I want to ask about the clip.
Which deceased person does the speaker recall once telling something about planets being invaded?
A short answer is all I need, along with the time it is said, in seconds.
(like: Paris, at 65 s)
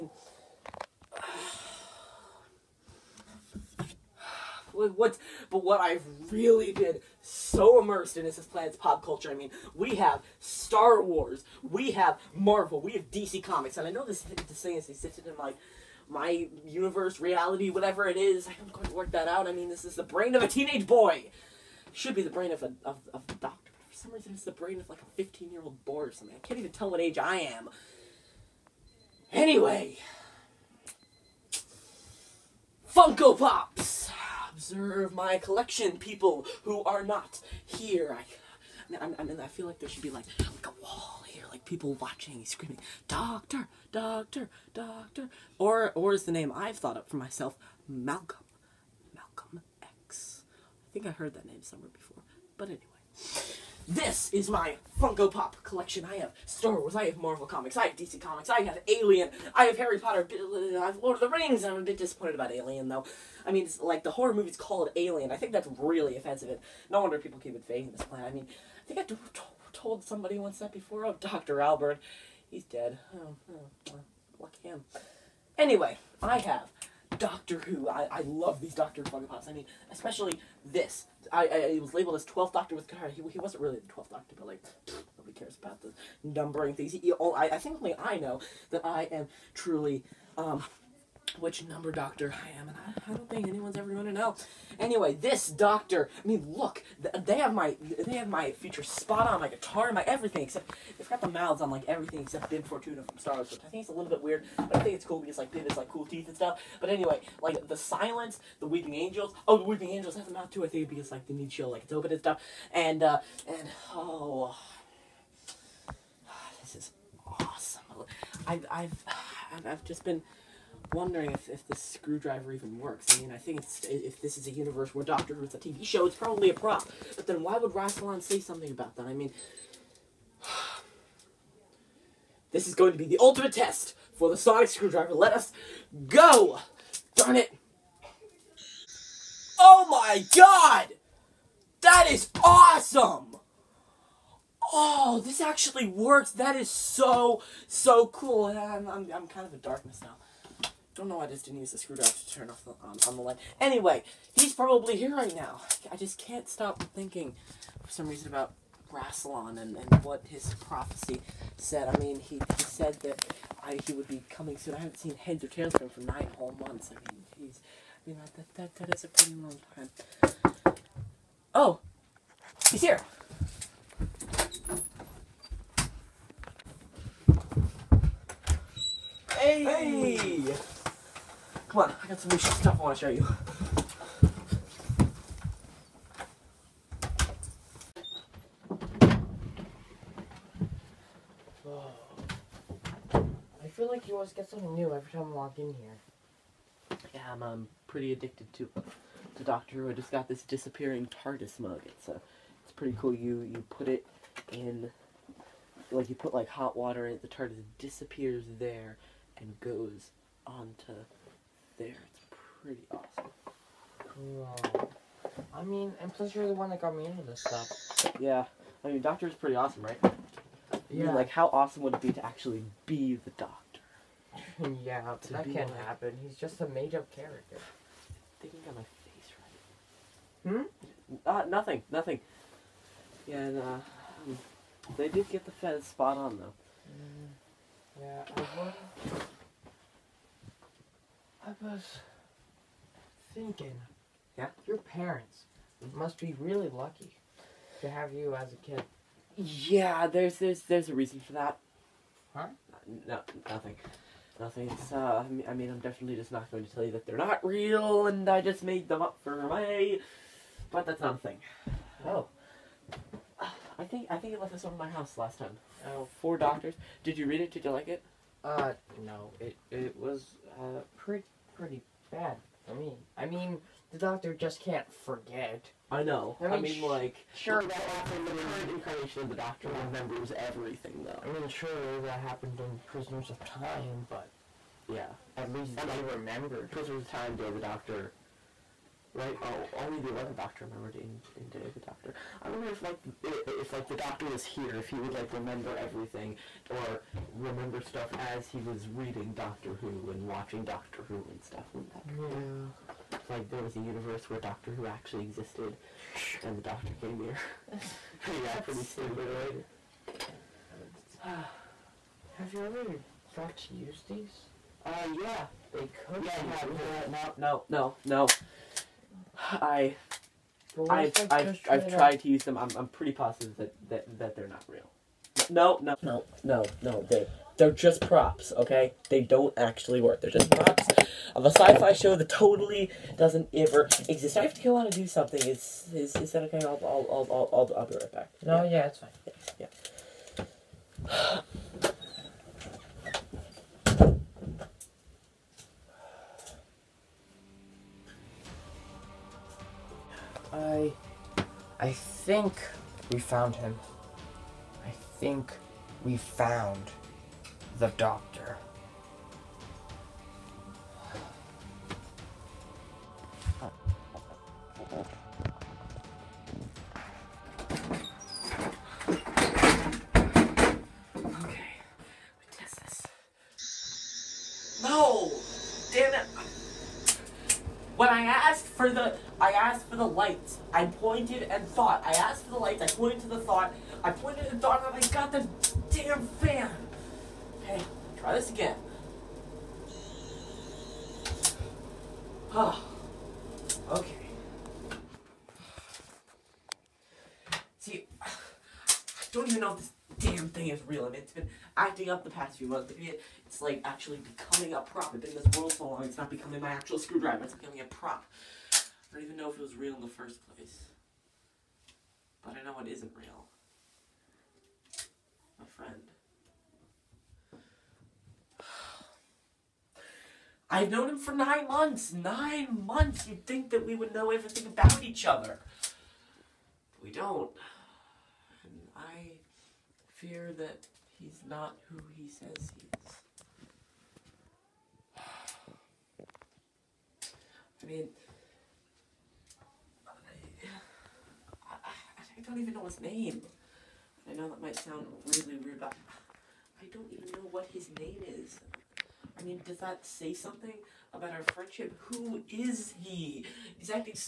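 Dr. Albert, at 71 s.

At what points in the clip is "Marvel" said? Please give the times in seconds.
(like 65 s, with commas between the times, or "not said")
12 s, 57 s.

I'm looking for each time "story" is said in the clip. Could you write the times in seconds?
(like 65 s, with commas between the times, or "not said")
not said.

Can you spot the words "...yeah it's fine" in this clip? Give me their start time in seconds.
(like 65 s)
338 s.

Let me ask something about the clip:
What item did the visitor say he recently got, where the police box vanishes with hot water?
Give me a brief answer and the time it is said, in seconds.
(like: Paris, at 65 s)
Disappearing TARDIS mug, at 200 s.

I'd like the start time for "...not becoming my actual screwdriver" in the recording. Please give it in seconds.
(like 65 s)
406 s.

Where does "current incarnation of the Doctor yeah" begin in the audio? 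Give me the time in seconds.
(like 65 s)
278 s.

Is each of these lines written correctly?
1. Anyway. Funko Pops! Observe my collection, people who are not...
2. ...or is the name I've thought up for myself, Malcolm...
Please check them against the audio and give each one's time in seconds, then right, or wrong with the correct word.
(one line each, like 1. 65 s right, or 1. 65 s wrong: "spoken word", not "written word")
1. 29 s right
2. 45 s right.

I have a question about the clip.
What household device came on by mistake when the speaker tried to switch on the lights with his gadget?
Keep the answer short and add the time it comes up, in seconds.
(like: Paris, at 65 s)
Fan, at 386 s.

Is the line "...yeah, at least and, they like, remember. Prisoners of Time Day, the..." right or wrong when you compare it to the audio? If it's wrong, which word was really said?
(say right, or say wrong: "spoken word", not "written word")
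right.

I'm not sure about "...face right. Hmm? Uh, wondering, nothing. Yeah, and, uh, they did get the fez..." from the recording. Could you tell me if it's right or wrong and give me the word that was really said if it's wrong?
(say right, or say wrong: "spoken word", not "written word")
wrong: "nothing", not "wondering".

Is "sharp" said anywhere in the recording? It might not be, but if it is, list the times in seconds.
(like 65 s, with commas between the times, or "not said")
not said.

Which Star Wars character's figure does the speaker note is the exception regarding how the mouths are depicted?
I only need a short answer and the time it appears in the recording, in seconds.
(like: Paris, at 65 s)
Bib Fortuna, at 102 s.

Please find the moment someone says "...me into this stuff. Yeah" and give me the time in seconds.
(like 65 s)
216 s.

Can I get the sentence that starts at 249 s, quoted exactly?
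Yeah, there's there's there's a reason for that.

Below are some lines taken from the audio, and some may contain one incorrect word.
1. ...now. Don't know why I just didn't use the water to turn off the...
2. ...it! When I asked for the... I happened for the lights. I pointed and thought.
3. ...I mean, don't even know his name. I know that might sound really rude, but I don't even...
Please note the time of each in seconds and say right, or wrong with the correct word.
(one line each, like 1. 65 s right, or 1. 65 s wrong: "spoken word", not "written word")
1. 150 s wrong: "screwdriver", not "water"
2. 376 s wrong: "asked", not "happened"
3. 437 s right.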